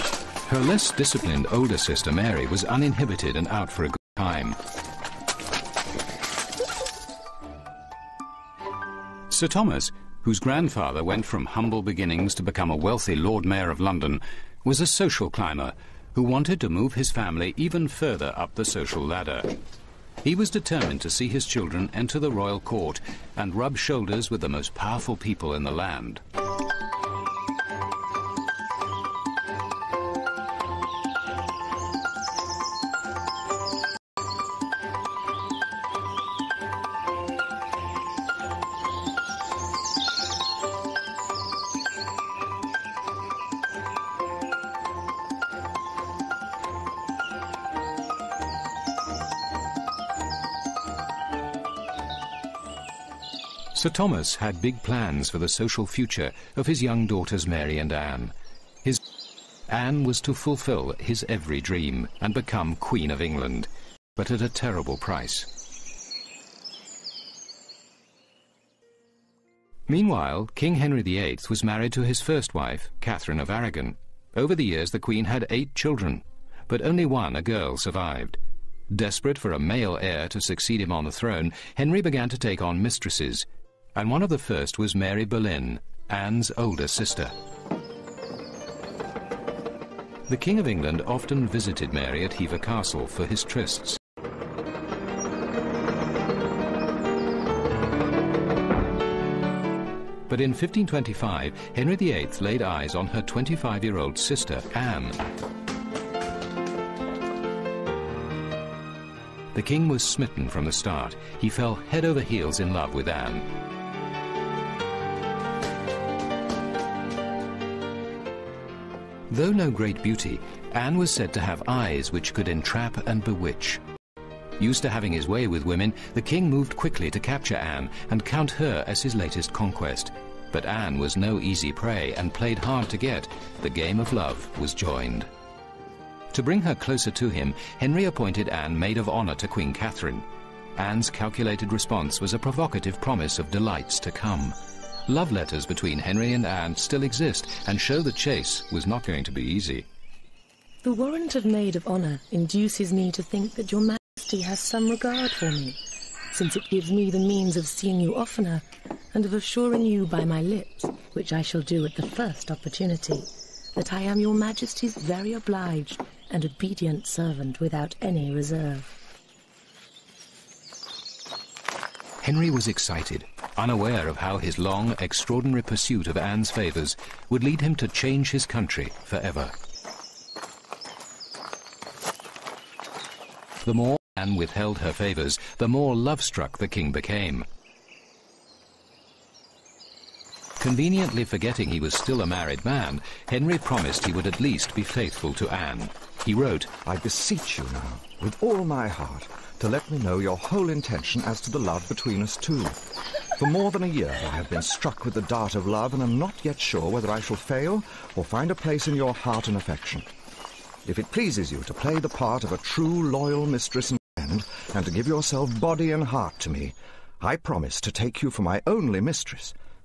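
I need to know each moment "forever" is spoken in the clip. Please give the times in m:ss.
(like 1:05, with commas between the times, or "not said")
2:59.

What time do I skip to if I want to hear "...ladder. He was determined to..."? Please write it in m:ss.
0:19.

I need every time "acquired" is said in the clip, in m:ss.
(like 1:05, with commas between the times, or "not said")
not said.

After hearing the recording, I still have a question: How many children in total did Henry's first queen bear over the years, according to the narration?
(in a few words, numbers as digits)
8.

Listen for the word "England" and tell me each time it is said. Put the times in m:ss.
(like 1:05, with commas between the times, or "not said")
1:03, 1:30.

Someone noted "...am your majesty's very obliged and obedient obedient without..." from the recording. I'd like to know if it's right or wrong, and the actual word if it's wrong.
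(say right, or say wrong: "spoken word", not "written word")
wrong: "servant", not "obedient".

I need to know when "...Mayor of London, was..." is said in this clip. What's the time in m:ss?
0:13.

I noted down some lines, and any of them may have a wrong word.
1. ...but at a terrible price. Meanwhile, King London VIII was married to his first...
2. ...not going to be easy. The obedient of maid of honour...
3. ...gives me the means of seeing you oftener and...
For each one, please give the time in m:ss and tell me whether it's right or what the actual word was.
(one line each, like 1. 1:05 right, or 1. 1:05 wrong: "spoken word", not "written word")
1. 1:04 wrong: "Henry", not "London"
2. 2:28 wrong: "warrant", not "obedient"
3. 2:36 right.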